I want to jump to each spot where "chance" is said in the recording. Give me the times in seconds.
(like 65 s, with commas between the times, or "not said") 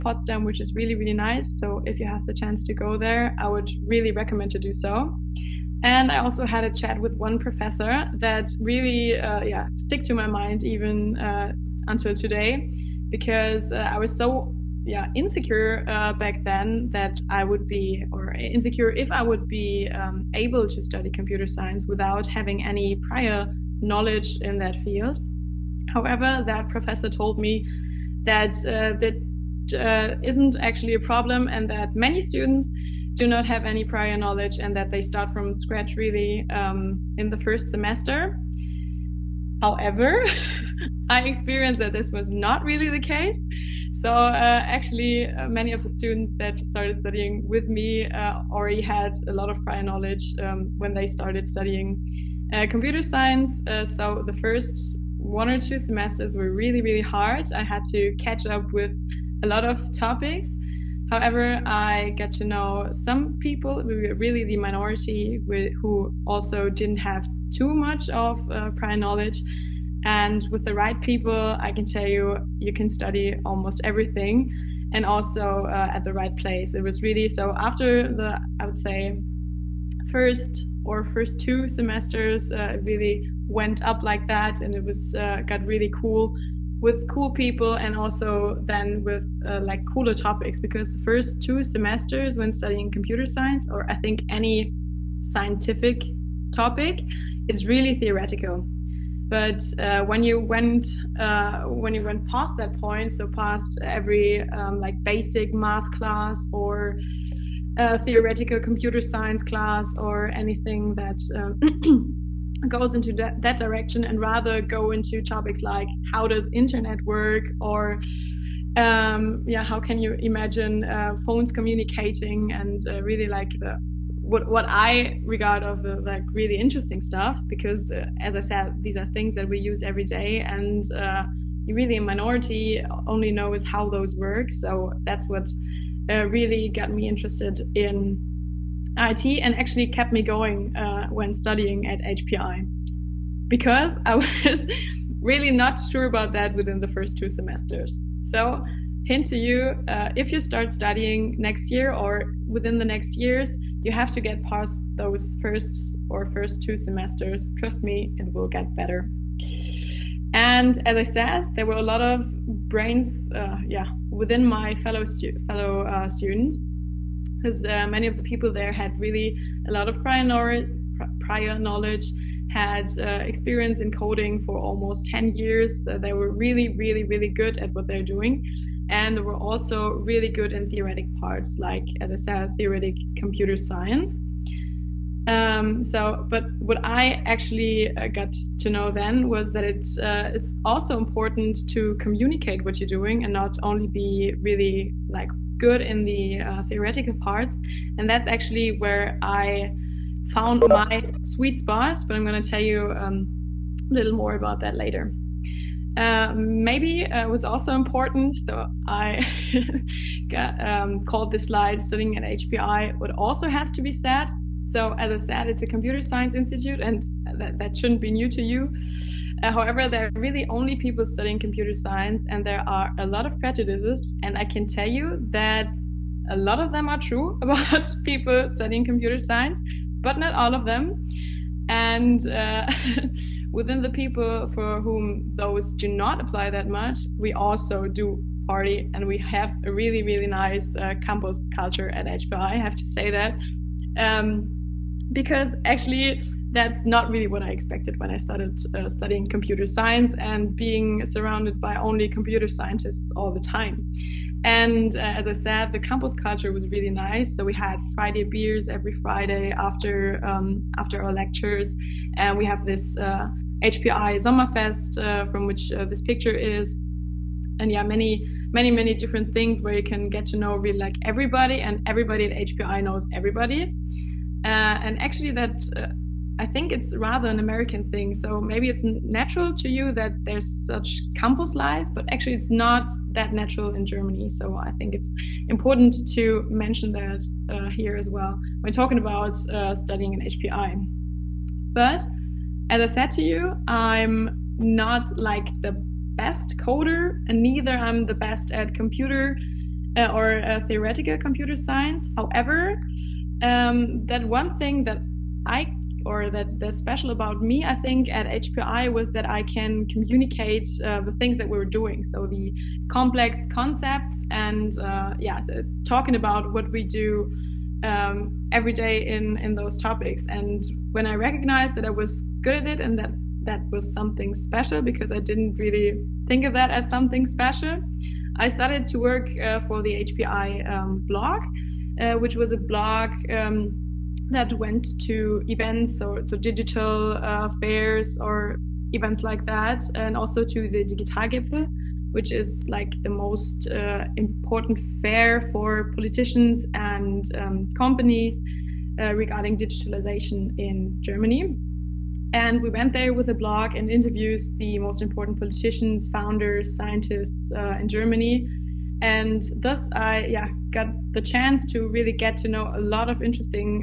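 2 s, 361 s.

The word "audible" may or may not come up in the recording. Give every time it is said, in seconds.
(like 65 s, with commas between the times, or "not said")
not said.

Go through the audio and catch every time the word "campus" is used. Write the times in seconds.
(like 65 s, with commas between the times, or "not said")
241 s, 255 s, 281 s.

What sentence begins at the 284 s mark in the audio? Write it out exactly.
So I think it's important to mention that uh, here as well when talking about uh, studying in HPI.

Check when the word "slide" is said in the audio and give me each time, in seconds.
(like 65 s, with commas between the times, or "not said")
211 s.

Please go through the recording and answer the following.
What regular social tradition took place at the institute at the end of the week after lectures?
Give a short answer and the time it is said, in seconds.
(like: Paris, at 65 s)
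Friday beers, at 257 s.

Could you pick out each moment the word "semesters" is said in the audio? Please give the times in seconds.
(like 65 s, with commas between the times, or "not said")
37 s, 55 s, 81 s, 91 s, 147 s, 156 s.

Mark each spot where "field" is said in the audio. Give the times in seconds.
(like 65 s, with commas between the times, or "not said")
24 s.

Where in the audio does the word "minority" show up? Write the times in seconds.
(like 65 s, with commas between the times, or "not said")
64 s, 132 s.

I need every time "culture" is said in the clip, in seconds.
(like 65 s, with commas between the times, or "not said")
241 s, 256 s.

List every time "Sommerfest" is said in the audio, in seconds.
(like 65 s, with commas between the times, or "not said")
264 s.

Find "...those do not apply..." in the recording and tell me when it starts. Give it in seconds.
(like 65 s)
235 s.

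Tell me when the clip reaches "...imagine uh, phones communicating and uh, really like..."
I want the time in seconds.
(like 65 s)
120 s.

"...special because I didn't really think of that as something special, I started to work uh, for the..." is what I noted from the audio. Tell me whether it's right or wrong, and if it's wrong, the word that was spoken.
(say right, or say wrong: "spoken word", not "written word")
right.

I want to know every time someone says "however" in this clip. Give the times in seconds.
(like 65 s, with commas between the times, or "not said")
25 s, 39 s, 61 s, 219 s, 302 s.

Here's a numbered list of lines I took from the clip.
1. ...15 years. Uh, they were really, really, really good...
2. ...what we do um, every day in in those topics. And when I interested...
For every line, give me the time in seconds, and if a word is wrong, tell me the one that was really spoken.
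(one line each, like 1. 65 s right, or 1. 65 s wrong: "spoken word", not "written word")
1. 175 s wrong: "10", not "15"
2. 316 s wrong: "recognized", not "interested".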